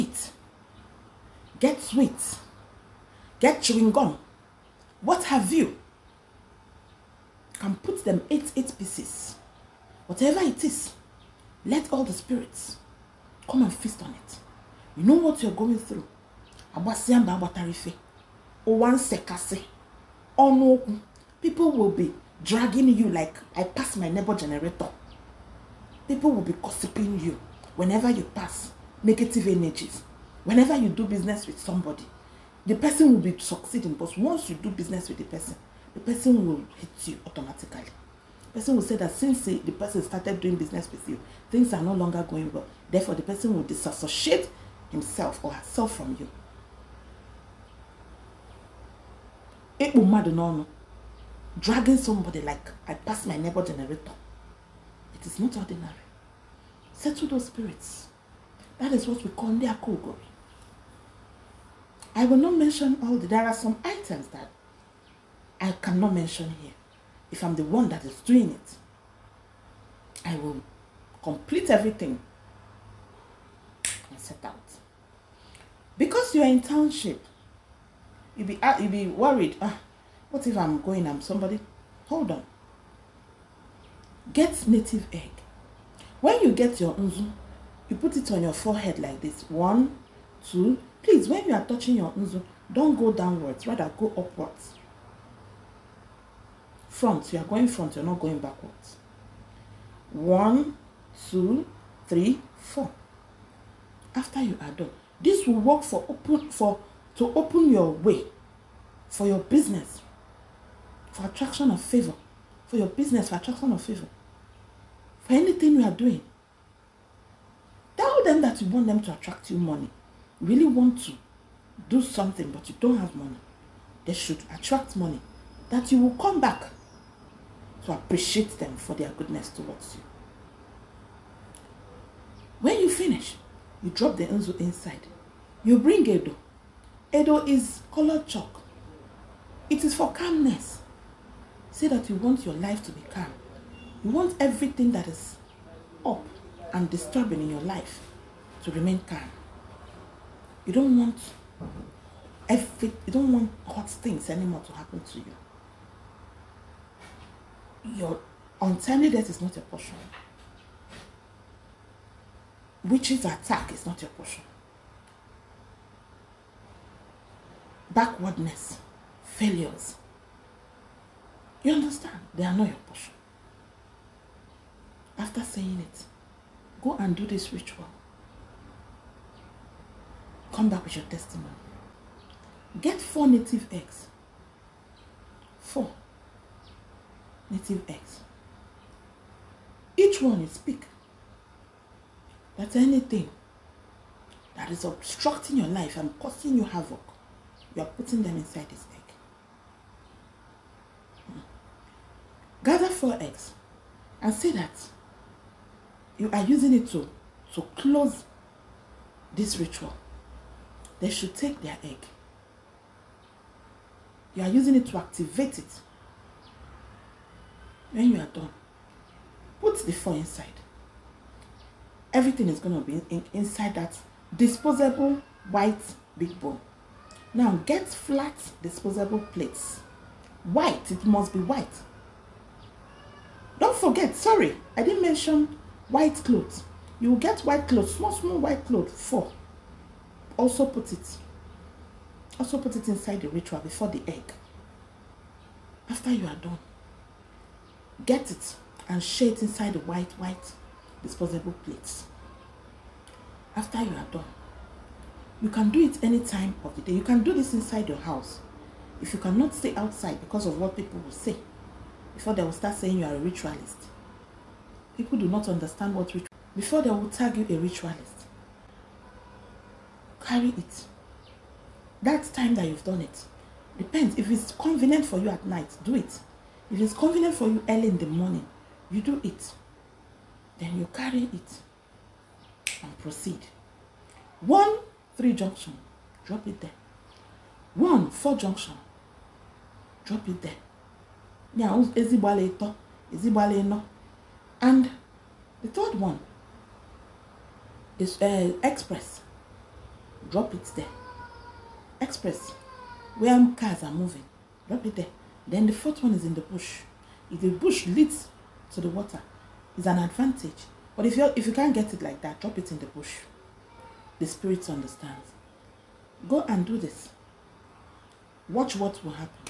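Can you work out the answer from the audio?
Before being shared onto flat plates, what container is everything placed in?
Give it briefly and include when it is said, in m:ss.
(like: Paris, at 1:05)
Disposable white big bowl, at 3:44.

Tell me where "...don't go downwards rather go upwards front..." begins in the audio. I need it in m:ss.
1:32.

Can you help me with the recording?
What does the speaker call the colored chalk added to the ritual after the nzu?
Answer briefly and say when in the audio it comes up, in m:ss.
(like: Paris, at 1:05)
Edo, at 2:17.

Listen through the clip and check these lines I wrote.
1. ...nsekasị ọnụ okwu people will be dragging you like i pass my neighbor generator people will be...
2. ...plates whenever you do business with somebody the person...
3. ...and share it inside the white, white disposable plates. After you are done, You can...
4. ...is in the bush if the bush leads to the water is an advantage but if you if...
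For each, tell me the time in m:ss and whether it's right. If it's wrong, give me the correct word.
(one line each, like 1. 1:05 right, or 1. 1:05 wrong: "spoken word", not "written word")
1. 0:18 right
2. 0:29 wrong: "energies", not "plates"
3. 4:08 right
4. 5:06 right.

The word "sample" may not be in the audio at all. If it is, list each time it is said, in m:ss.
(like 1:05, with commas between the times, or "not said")
not said.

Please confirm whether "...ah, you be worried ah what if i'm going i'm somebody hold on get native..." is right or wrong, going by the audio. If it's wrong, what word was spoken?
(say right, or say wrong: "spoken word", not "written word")
right.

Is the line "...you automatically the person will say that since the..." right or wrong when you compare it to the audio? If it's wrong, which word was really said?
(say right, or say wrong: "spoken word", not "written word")
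right.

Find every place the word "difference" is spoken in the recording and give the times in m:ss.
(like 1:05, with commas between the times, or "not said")
not said.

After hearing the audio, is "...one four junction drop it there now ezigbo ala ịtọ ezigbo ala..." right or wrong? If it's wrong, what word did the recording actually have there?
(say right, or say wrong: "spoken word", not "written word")
right.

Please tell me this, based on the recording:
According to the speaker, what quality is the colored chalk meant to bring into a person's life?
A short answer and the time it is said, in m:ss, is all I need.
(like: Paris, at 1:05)
Calmness, at 2:20.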